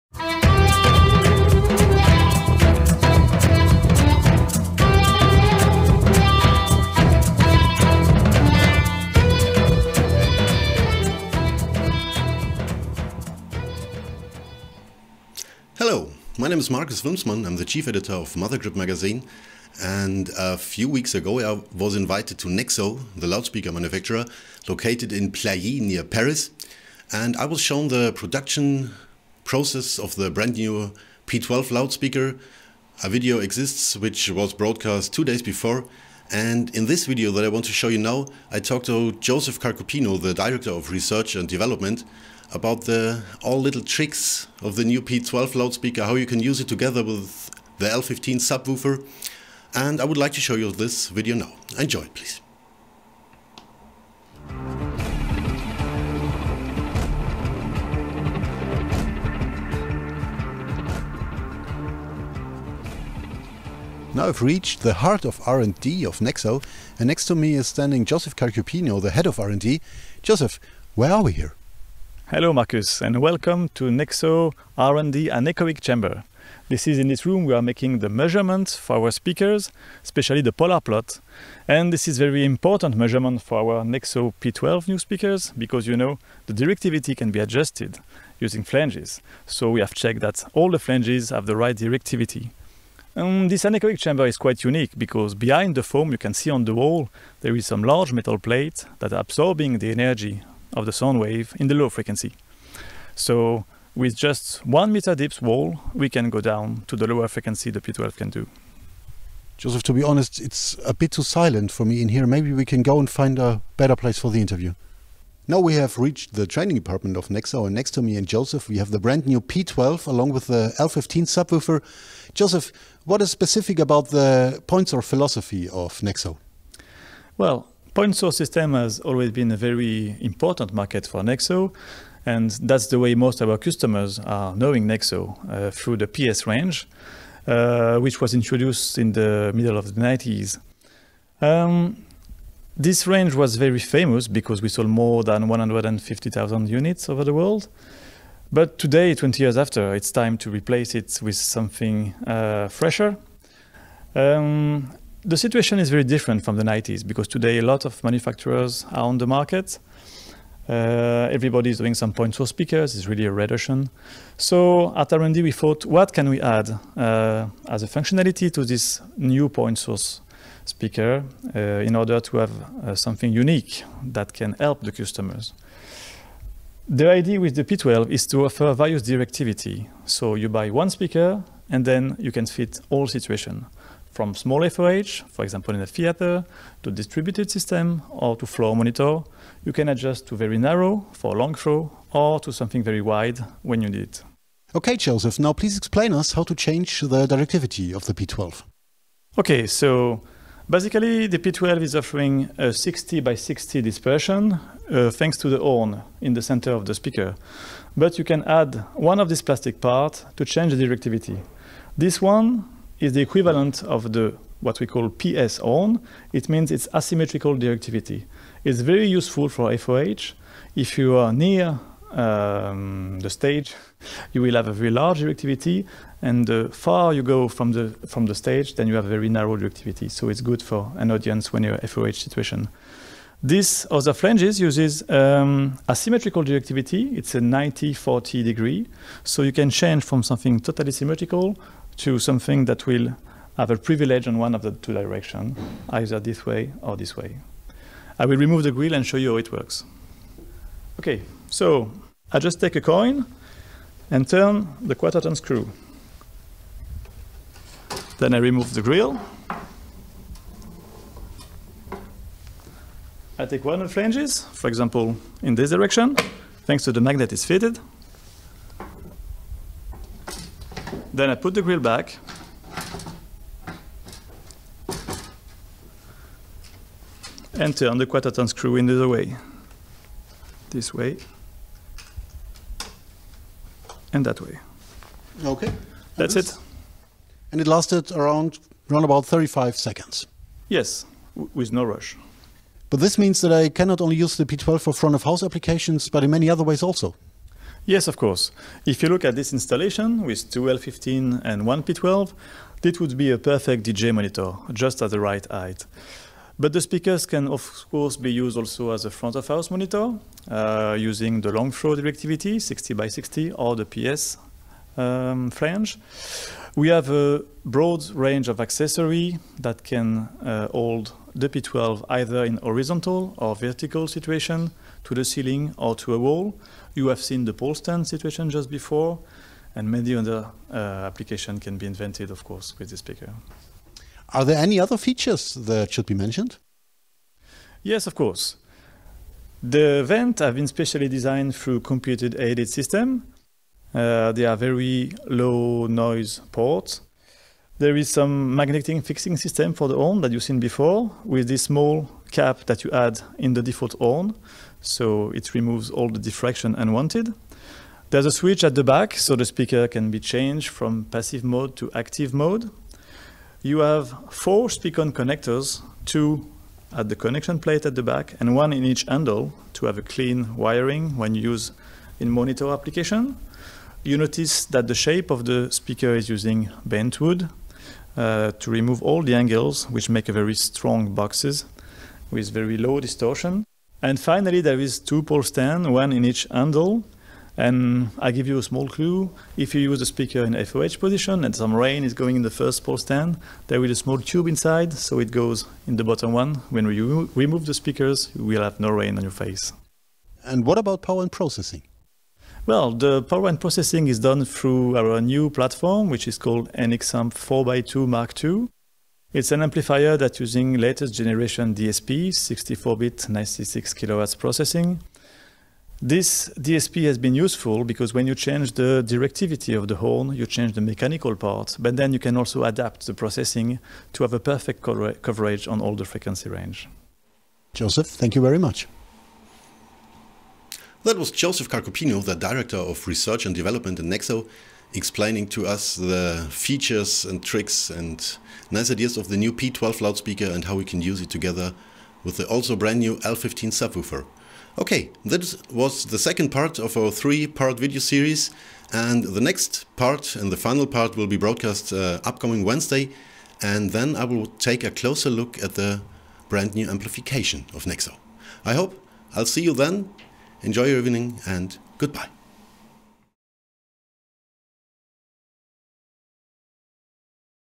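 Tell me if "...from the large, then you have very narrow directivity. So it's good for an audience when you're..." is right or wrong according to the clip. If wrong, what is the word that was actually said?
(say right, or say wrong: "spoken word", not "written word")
wrong: "stage", not "large".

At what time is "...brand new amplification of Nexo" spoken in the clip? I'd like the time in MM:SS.
07:36.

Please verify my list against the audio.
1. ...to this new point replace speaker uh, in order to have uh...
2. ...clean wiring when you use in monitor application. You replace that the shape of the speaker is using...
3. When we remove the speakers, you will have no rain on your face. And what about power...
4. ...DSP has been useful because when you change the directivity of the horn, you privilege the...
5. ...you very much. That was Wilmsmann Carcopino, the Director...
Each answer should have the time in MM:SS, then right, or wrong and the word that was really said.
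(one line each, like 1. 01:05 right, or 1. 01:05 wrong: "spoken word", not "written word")
1. 02:48 wrong: "source", not "replace"
2. 06:10 wrong: "notice", not "replace"
3. 06:36 right
4. 06:56 wrong: "change", not "privilege"
5. 07:08 wrong: "Joseph", not "Wilmsmann".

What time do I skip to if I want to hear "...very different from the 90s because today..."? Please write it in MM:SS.
02:35.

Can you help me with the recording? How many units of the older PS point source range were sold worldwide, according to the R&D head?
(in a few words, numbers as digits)
More than 150,000.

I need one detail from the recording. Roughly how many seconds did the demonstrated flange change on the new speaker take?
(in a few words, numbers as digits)
35 seconds.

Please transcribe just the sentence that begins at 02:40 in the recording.
Uh, everybody is doing some point source speakers.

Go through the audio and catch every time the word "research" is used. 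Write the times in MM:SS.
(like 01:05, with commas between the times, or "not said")
00:40, 07:13.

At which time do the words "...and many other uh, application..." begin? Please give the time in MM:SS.
05:29.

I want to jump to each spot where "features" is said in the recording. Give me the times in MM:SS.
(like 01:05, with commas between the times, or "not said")
05:34, 07:16.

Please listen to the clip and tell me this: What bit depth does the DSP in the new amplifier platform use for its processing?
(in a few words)
64-bit.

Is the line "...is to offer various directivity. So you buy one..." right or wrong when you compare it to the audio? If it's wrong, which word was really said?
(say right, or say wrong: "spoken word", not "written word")
right.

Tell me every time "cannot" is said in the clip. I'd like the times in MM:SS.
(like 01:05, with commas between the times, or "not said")
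04:53.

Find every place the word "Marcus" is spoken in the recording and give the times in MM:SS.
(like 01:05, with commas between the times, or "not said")
00:16, 01:12.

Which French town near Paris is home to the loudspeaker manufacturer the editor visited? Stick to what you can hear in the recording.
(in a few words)
Plailly.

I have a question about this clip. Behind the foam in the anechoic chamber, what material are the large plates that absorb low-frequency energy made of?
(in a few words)
Metal.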